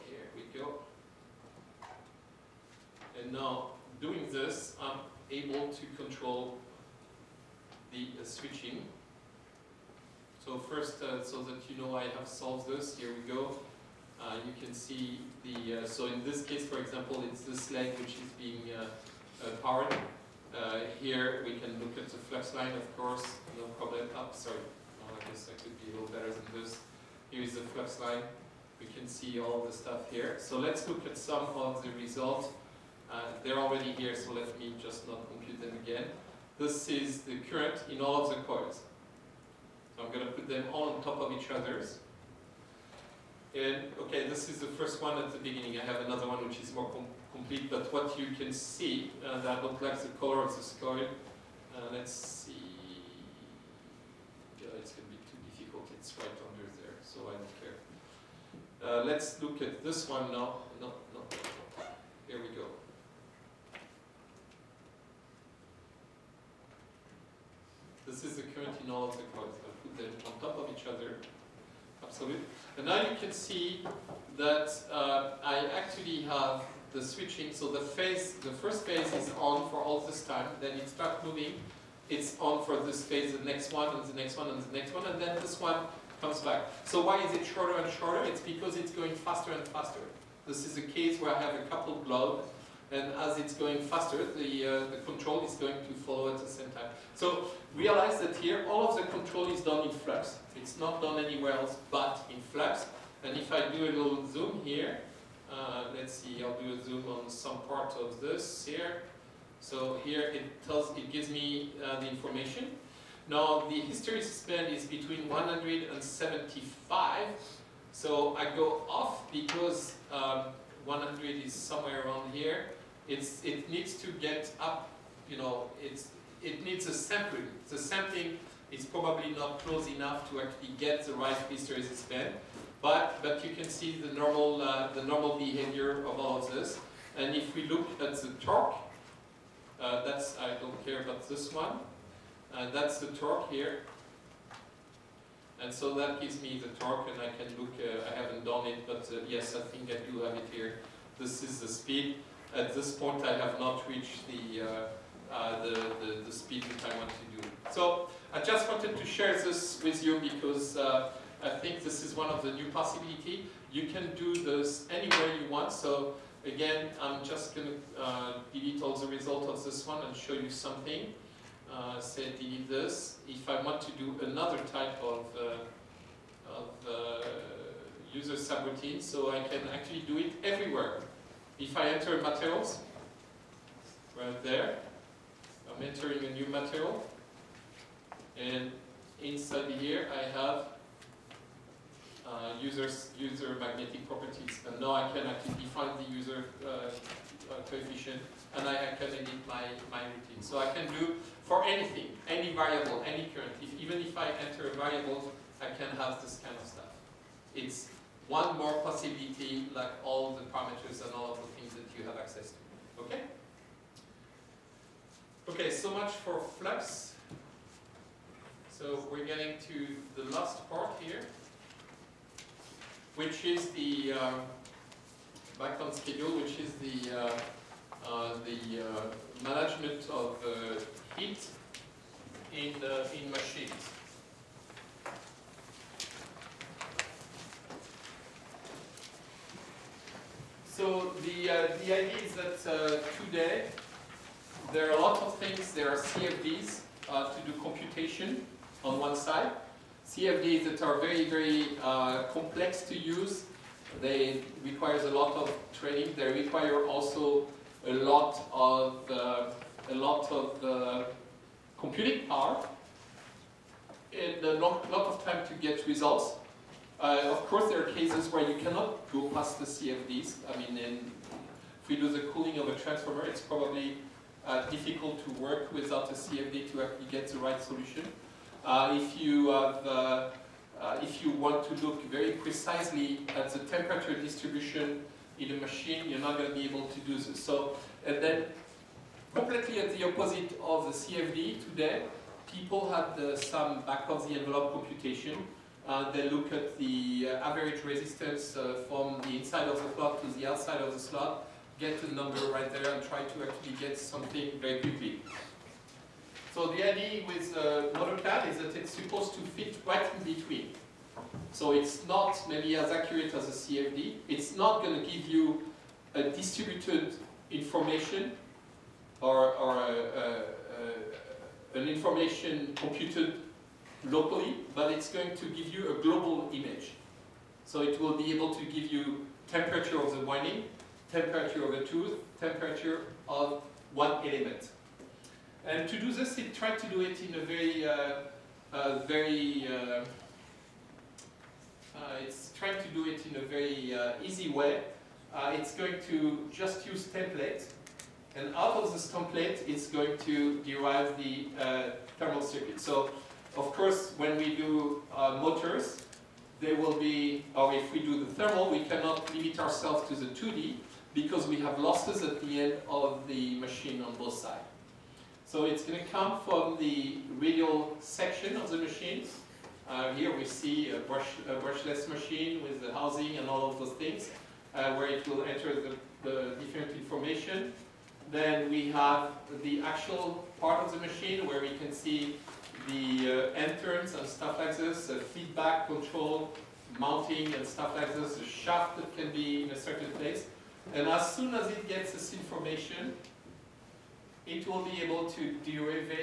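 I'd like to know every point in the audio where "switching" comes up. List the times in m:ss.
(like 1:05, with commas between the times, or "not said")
0:08, 1:17.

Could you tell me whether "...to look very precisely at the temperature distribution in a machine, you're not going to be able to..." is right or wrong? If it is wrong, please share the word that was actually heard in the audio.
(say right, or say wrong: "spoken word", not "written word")
right.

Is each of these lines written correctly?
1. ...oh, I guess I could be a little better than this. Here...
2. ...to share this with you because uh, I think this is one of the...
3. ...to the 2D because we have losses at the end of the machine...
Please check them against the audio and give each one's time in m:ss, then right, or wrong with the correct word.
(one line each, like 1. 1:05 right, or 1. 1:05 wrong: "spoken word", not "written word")
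1. 0:25 right
2. 2:38 right
3. 6:00 right.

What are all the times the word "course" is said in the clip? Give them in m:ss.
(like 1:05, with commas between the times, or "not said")
0:22, 4:27, 5:53.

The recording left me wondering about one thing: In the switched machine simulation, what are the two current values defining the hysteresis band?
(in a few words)
100 and 75.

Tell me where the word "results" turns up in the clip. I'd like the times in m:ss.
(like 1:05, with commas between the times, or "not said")
0:32, 2:49, 4:25.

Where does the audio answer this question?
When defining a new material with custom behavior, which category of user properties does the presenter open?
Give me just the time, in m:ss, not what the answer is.
3:13.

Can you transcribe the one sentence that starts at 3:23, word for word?
If, even if I enter a variable, I can have this kind of stuff.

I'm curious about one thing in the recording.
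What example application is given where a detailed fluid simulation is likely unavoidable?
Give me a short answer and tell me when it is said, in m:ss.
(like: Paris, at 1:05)
Cooling of a transformer, at 4:32.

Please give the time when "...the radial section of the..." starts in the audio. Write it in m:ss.
6:06.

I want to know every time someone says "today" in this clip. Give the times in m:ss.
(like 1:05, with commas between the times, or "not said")
4:03, 4:51.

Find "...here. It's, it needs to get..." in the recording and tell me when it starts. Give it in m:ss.
2:02.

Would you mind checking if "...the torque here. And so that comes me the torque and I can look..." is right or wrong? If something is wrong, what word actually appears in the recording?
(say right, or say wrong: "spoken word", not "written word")
wrong: "gives", not "comes".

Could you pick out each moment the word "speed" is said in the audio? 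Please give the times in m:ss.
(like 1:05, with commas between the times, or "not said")
2:31, 2:36.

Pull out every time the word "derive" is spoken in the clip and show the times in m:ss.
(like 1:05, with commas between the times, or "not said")
5:50, 6:35.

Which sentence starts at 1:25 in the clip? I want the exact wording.
And then this one comes back.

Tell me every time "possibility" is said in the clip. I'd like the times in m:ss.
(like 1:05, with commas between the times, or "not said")
2:42, 3:28.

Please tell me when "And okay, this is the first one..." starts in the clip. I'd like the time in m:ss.
0:43.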